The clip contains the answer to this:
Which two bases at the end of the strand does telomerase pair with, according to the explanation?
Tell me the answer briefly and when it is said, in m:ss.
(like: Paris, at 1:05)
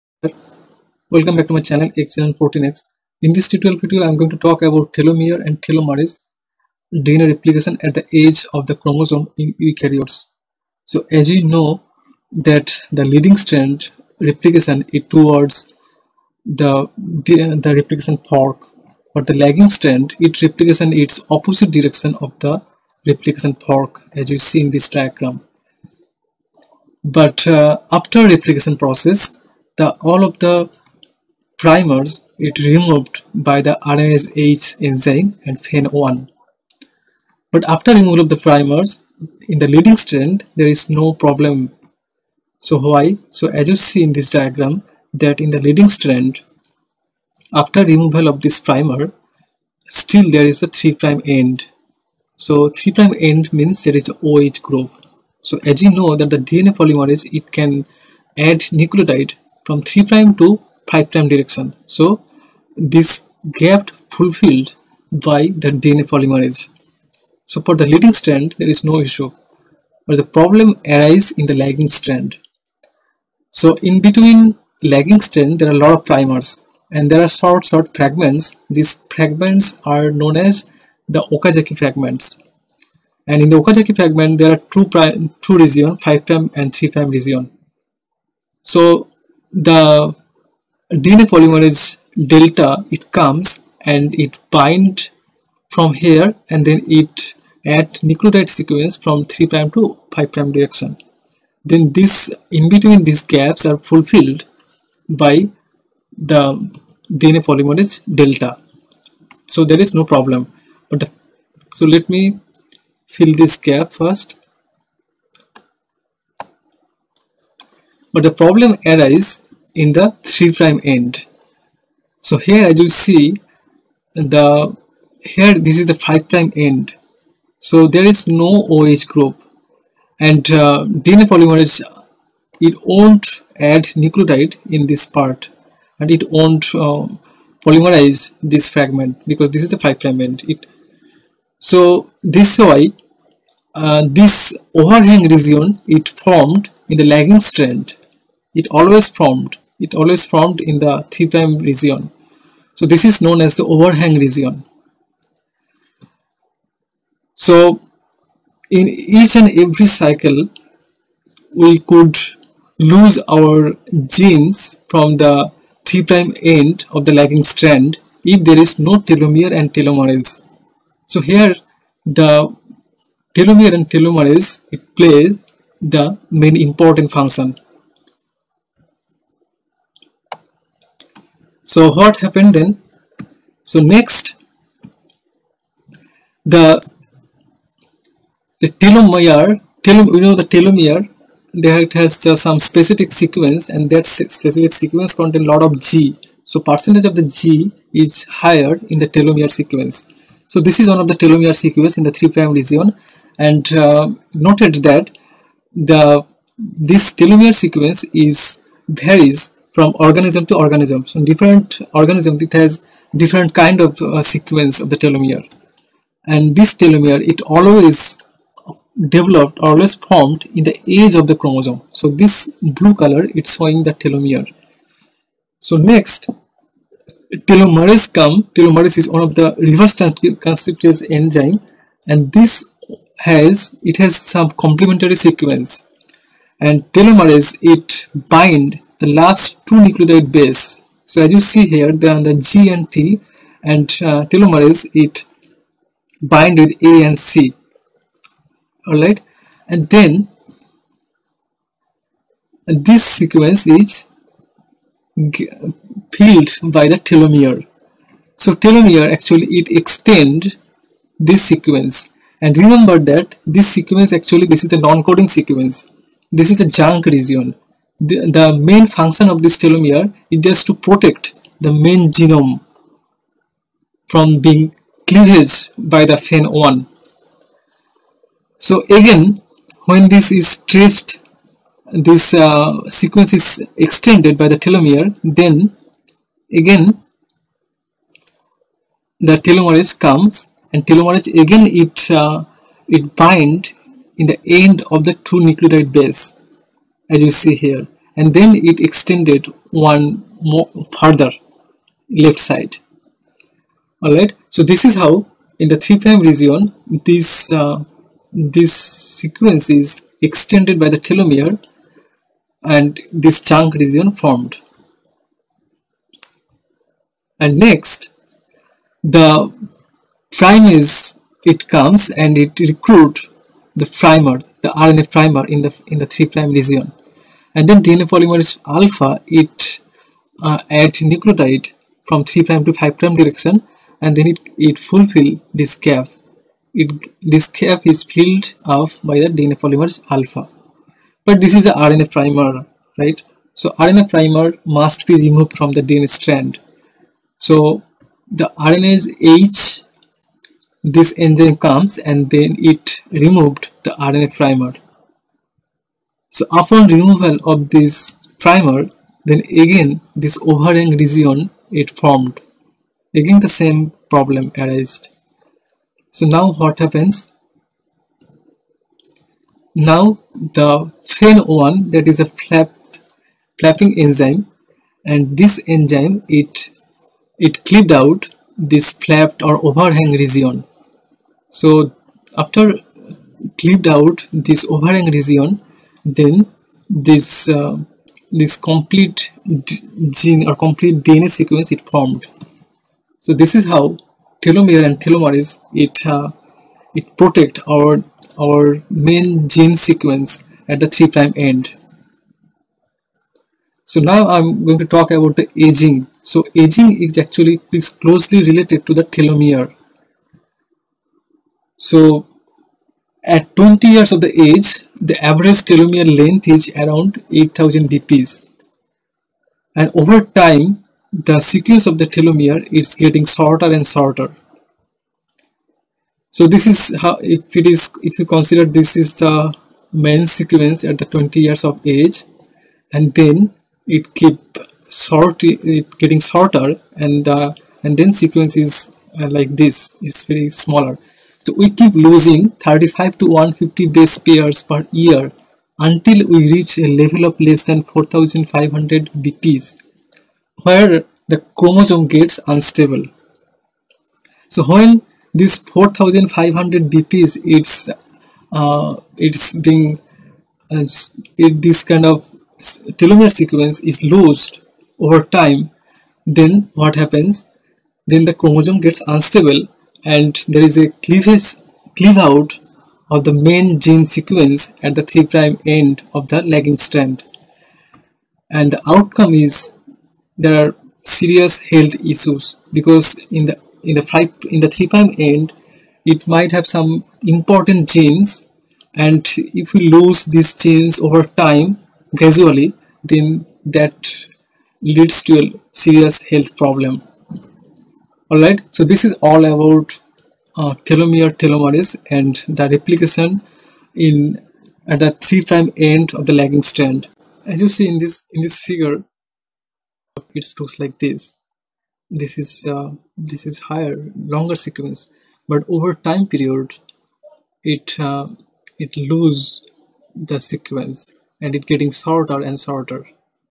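A and C, at 4:06.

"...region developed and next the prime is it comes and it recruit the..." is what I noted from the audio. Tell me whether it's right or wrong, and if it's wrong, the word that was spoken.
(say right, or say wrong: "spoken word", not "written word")
wrong: "formed", not "developed".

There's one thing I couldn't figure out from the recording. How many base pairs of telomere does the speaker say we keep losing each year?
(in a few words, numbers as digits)
35 to 150.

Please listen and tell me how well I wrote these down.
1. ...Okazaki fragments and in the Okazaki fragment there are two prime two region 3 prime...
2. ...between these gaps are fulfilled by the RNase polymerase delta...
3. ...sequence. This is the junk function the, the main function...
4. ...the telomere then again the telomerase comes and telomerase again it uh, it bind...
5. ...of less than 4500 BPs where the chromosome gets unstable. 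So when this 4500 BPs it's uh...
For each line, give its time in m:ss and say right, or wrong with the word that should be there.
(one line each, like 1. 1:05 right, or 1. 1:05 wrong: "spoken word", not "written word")
1. 1:21 wrong: "5", not "3"
2. 1:42 wrong: "DNA", not "RNase"
3. 4:25 wrong: "region", not "function"
4. 4:44 right
5. 7:27 right.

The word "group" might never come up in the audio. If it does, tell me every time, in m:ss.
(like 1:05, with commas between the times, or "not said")
0:54, 2:09.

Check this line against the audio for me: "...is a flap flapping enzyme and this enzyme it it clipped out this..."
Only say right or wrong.
right.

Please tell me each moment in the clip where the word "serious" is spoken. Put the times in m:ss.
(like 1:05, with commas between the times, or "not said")
8:01, 8:15.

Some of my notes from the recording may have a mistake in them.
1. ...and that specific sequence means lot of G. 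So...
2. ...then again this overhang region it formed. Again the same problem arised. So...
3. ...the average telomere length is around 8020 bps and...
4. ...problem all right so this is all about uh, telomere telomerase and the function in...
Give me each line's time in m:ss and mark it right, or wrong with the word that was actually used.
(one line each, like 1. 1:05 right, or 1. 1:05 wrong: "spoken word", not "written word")
1. 3:13 wrong: "contains", not "means"
2. 5:59 right
3. 6:55 wrong: "8000", not "8020"
4. 8:16 wrong: "replication", not "function".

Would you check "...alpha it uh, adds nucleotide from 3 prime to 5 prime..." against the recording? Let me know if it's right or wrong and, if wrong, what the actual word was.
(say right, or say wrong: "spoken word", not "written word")
right.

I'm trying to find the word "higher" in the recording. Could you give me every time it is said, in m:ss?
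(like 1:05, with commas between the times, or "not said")
3:18, 8:33.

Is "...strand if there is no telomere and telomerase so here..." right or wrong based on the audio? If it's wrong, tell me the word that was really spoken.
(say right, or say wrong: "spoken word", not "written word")
right.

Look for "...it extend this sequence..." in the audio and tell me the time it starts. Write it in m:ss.
4:19.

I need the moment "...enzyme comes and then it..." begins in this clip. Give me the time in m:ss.
5:51.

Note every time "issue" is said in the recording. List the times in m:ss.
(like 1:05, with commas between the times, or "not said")
1:09, 8:02.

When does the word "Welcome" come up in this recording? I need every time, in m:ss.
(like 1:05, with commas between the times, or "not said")
0:01.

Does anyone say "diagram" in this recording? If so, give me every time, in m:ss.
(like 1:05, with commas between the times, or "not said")
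0:24, 0:44.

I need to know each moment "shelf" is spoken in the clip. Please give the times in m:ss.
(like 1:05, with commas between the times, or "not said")
not said.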